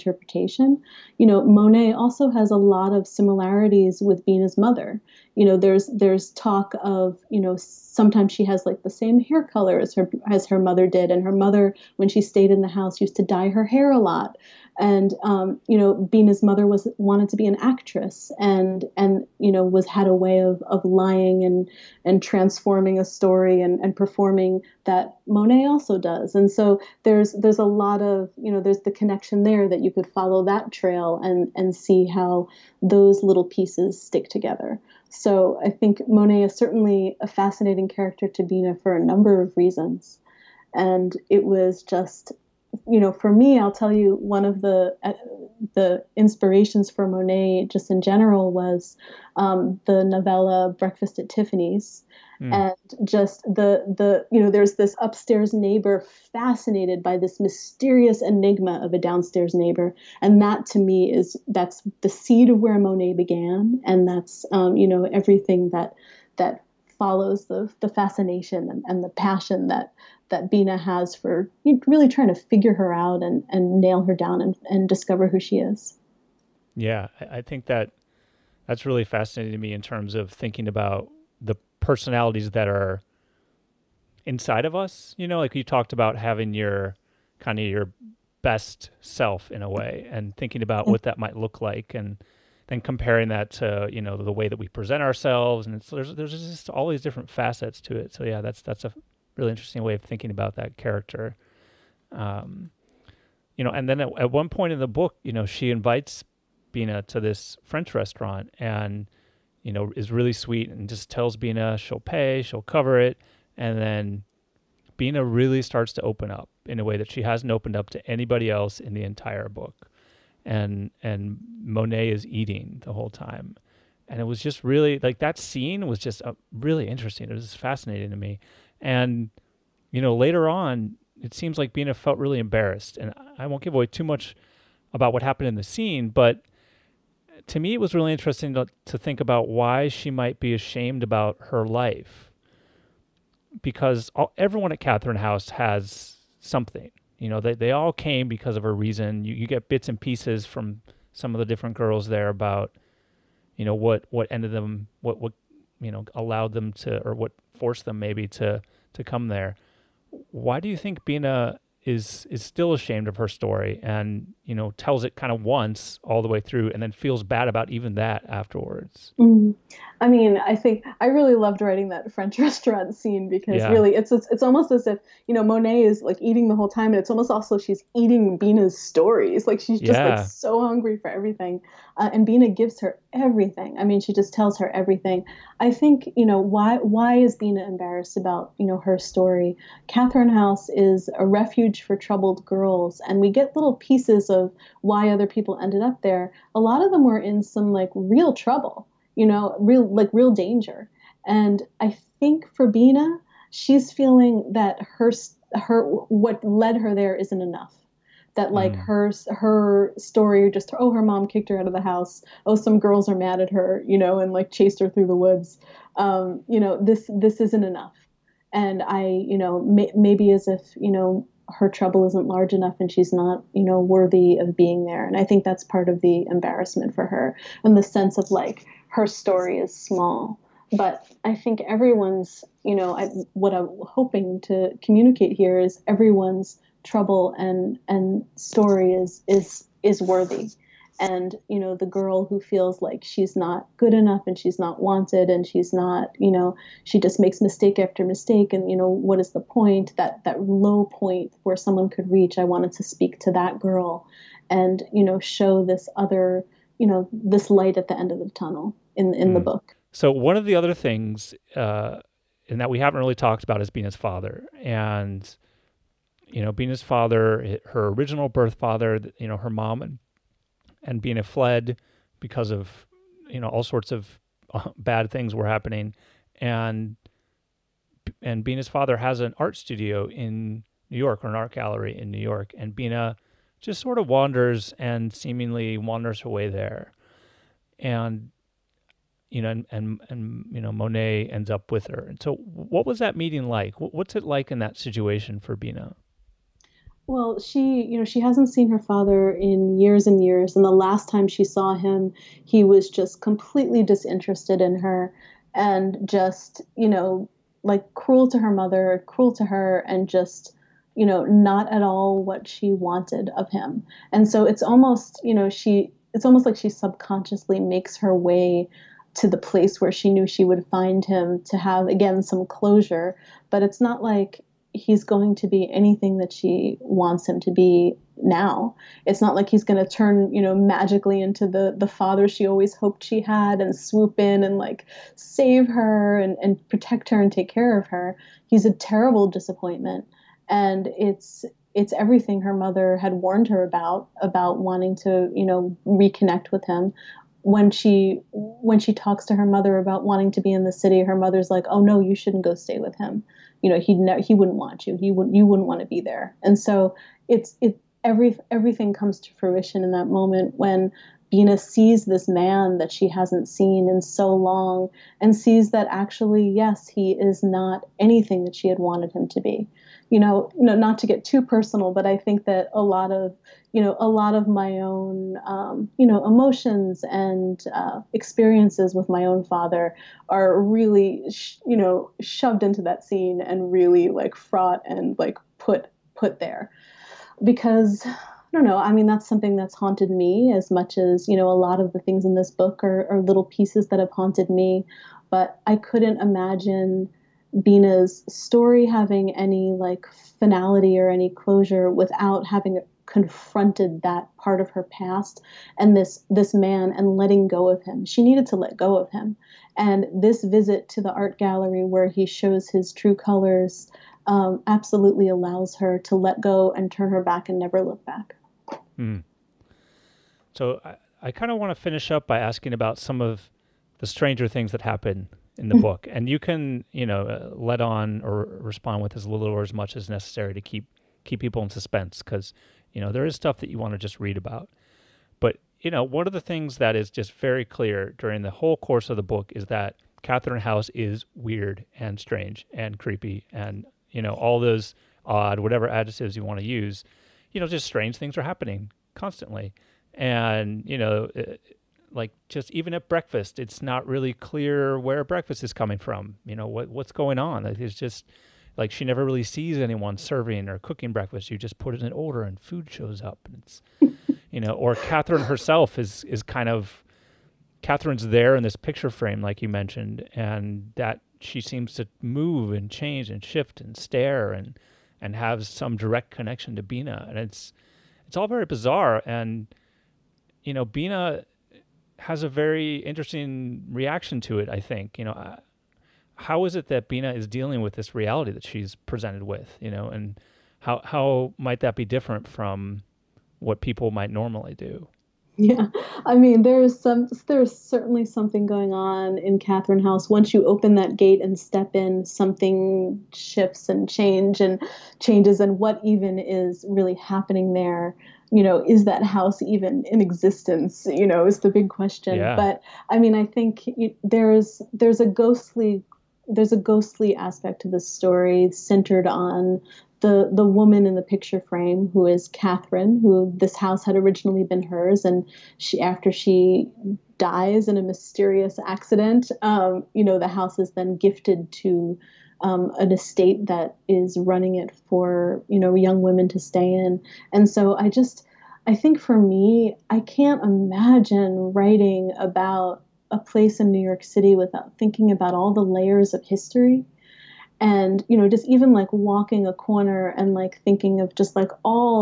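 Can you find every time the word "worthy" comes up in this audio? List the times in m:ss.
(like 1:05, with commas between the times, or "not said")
3:43, 4:00.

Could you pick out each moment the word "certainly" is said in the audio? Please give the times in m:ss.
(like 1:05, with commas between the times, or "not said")
0:36, 8:17.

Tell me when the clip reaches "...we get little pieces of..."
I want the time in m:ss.
3:13.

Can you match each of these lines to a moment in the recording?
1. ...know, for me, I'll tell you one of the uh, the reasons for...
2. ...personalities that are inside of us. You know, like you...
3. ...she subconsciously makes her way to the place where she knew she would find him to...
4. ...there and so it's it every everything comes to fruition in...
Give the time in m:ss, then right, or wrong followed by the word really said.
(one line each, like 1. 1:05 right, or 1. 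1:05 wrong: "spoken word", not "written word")
1. 0:42 wrong: "inspirations", not "reasons"
2. 1:21 right
3. 5:16 right
4. 5:56 right.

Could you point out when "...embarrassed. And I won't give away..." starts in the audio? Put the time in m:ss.
2:12.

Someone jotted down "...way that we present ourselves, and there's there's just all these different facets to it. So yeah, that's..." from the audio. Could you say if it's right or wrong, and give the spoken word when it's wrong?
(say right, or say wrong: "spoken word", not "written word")
right.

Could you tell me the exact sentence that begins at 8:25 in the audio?
And what even is really happening there?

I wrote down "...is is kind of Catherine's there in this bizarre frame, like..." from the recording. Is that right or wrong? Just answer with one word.
wrong.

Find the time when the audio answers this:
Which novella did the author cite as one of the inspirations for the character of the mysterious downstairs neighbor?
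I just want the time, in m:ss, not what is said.
0:50.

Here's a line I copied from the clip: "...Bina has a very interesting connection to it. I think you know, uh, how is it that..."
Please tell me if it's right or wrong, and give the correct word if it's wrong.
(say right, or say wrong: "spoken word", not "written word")
wrong: "reaction", not "connection".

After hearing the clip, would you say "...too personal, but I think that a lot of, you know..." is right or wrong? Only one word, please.
right.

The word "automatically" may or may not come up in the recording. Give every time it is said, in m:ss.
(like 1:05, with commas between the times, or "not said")
not said.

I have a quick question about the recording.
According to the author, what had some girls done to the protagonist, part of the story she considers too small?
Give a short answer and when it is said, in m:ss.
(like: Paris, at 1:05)
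Chased her through the woods, at 3:34.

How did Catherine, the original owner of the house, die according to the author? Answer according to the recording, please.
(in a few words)
Mysterious accident.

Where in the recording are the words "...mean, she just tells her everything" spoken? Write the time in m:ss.
3:03.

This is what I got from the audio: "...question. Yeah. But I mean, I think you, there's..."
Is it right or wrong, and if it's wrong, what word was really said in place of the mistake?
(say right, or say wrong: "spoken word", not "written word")
right.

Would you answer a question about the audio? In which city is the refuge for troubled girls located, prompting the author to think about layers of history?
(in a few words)
New York City.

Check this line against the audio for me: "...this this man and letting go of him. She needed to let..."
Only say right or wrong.
right.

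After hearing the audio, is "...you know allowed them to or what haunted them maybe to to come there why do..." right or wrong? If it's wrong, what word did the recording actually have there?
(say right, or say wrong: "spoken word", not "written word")
wrong: "forced", not "haunted".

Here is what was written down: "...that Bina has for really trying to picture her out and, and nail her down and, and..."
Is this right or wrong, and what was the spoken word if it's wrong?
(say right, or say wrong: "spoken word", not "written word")
wrong: "figure", not "picture".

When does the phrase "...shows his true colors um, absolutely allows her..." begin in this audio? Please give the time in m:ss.
6:52.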